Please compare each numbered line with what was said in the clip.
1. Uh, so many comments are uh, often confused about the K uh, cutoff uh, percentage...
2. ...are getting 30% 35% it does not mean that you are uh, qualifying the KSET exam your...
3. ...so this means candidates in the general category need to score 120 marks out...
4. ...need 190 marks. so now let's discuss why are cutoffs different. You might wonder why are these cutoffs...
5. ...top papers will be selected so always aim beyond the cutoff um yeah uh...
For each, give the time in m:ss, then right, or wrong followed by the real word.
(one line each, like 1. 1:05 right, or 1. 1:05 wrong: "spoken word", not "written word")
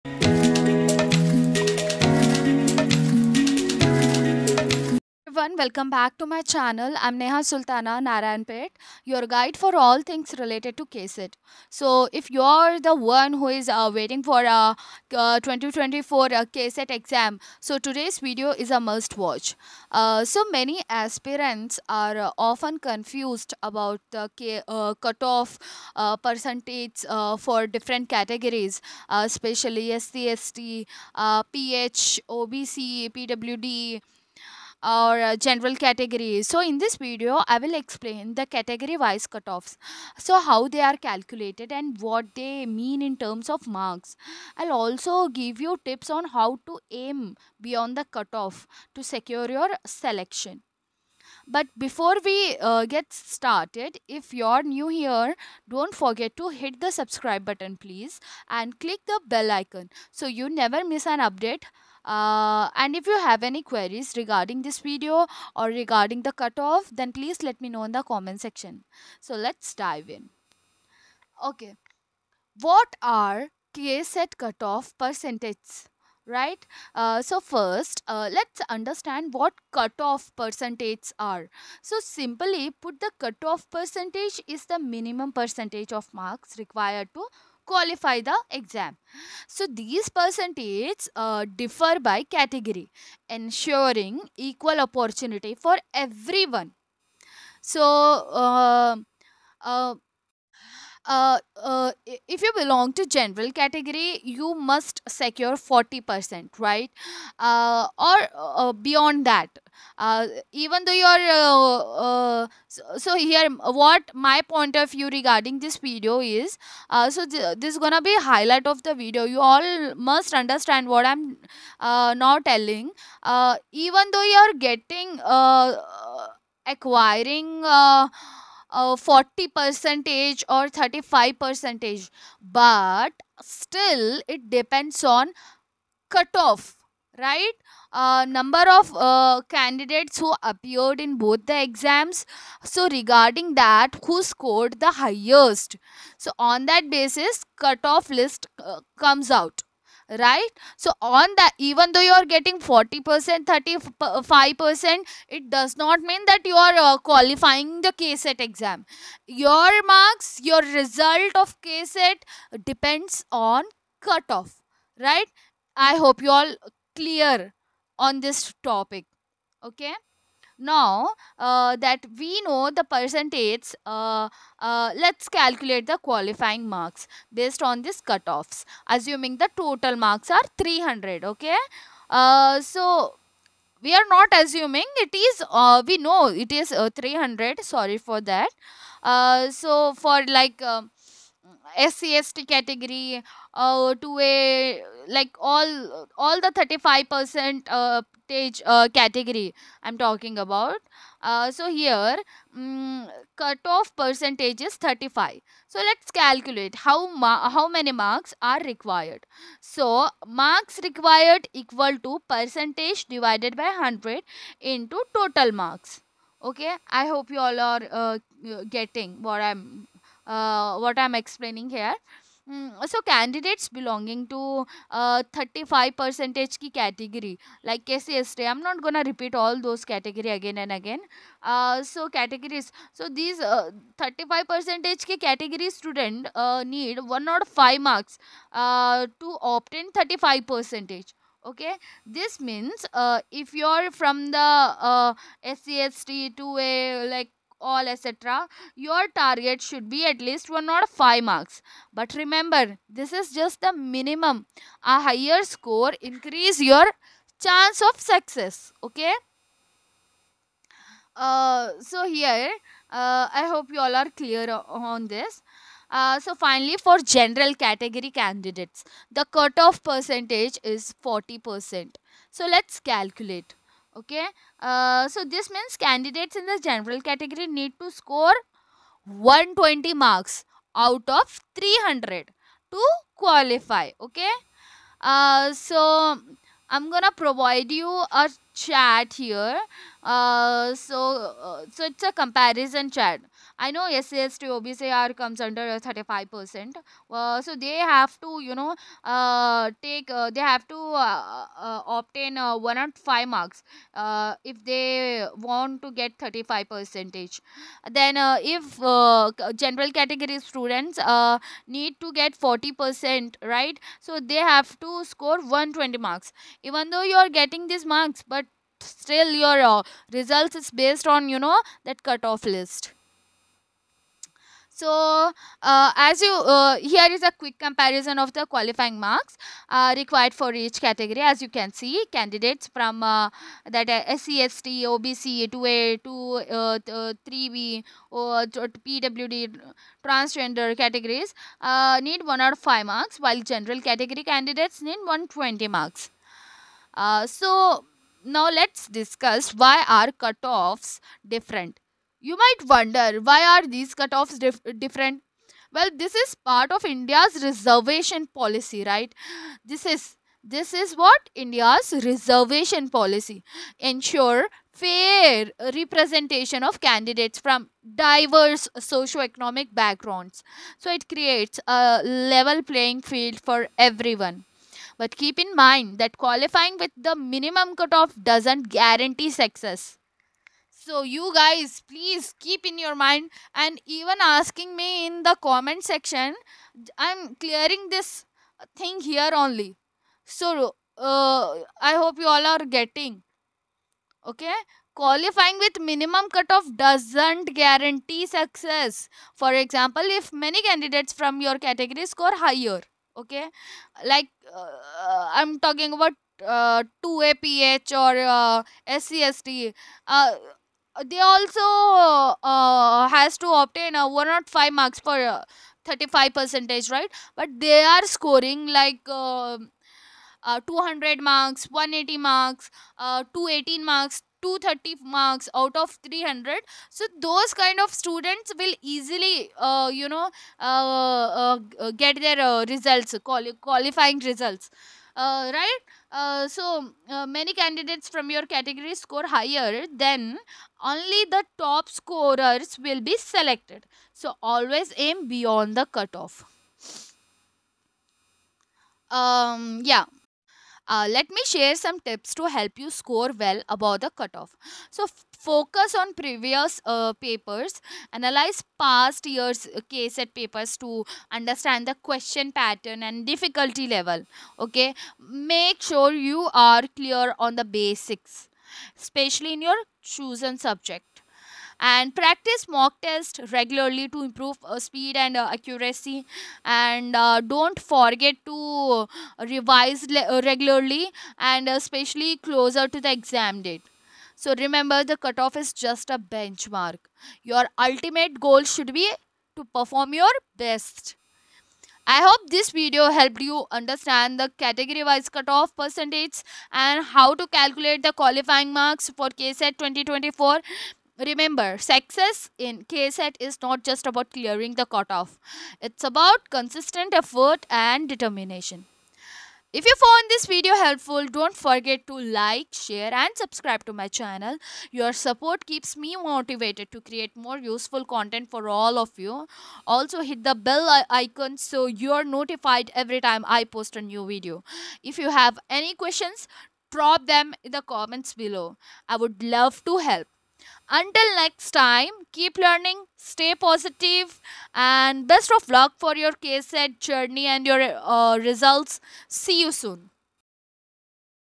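1. 0:19 wrong: "aspirants", not "comments"
2. 2:32 wrong: "40", not "30"
3. 4:35 right
4. 5:44 wrong: "120", not "190"
5. 7:21 wrong: "scorers", not "papers".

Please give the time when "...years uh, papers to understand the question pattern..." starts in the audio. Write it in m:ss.
7:39.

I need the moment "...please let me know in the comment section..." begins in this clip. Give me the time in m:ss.
1:07.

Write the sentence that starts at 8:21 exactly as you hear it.
Remember, success in KSET is not just about clearing the cutoff.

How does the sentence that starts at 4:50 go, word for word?
Uh, so, uh, so it's a comparison chat.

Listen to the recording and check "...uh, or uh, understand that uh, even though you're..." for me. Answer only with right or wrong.
wrong.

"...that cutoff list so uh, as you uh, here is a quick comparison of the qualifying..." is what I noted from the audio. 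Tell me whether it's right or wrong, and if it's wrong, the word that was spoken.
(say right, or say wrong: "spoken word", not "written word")
right.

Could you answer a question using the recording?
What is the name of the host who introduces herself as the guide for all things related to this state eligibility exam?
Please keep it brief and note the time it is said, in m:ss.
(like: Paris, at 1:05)
Neha Sultana Narayanpet, at 0:07.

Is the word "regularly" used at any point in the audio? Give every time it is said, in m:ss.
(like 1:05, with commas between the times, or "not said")
7:53, 8:00.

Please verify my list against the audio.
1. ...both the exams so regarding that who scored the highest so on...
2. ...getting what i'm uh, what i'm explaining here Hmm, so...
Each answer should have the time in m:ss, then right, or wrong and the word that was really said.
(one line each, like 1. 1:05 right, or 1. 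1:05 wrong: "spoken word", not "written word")
1. 2:21 right
2. 3:38 right.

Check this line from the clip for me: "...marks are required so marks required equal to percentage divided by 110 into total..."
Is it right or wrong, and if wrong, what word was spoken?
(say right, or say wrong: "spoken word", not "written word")
wrong: "100", not "110".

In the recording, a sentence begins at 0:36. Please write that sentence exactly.
So in this video, I will explain the category wise cutoffs.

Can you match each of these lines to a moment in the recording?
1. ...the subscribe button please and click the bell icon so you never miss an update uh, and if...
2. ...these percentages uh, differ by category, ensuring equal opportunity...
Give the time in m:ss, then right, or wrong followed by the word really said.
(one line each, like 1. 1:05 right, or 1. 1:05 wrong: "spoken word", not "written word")
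1. 0:56 right
2. 1:29 right.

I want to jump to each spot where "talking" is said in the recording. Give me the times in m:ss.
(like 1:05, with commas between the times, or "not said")
3:20, 6:45.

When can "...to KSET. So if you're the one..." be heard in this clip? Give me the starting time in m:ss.
0:10.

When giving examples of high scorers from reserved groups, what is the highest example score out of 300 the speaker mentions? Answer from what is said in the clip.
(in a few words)
230.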